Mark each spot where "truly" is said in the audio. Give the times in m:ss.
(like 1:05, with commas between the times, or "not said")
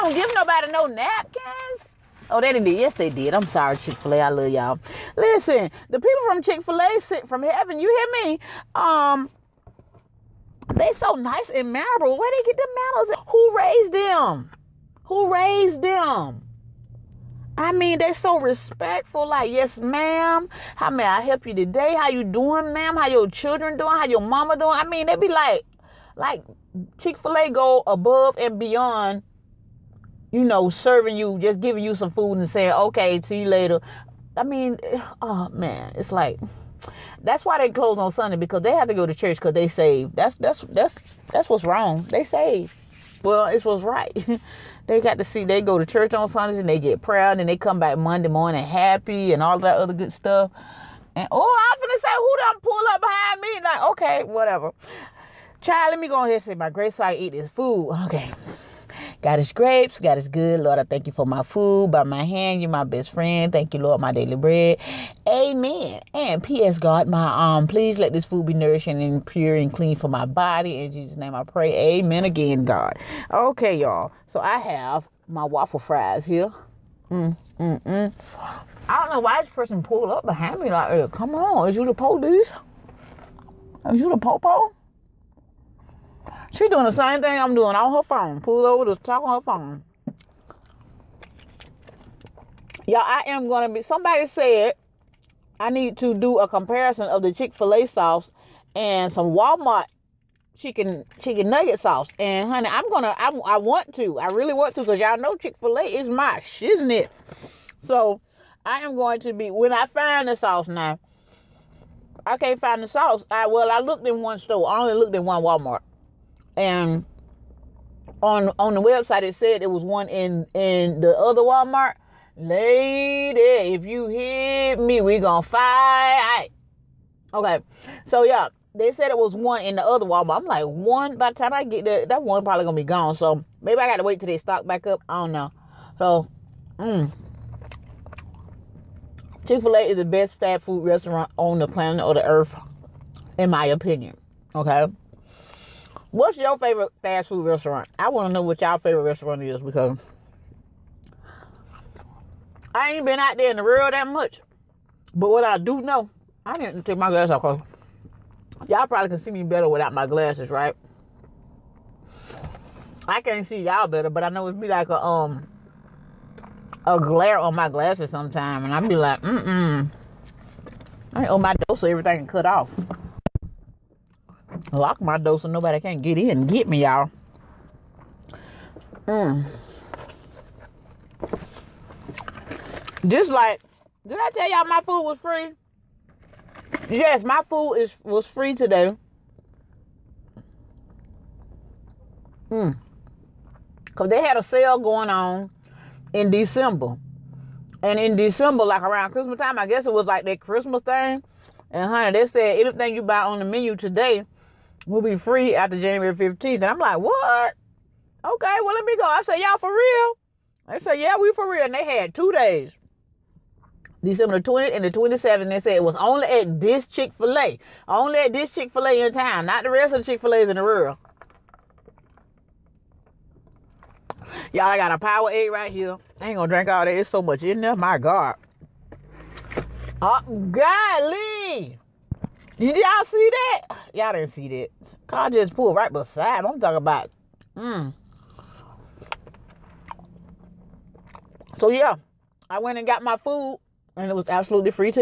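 not said.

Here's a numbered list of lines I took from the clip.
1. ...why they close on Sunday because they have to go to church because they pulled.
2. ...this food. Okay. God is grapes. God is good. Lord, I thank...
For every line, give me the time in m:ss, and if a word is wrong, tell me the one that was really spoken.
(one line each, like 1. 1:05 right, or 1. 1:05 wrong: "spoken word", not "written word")
1. 0:37 wrong: "saved", not "pulled"
2. 0:57 right.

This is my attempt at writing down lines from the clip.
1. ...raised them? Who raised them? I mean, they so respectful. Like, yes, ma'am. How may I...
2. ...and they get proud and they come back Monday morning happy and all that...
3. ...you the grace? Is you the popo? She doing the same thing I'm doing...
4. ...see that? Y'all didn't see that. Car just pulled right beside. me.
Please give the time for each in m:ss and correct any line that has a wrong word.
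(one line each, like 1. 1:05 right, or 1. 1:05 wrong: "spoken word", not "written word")
1. 0:13 right
2. 0:46 right
3. 1:21 wrong: "police", not "grace"
4. 3:53 right.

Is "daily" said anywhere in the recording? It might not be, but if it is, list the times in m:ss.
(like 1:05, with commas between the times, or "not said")
1:04.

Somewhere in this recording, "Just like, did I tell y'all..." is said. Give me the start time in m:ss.
3:03.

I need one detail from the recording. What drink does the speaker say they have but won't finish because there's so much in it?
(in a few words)
Powerade.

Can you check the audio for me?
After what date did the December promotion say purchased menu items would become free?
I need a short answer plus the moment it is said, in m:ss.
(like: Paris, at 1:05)
January 15th, at 3:25.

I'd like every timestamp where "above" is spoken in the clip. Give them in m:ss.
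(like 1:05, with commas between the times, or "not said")
0:27.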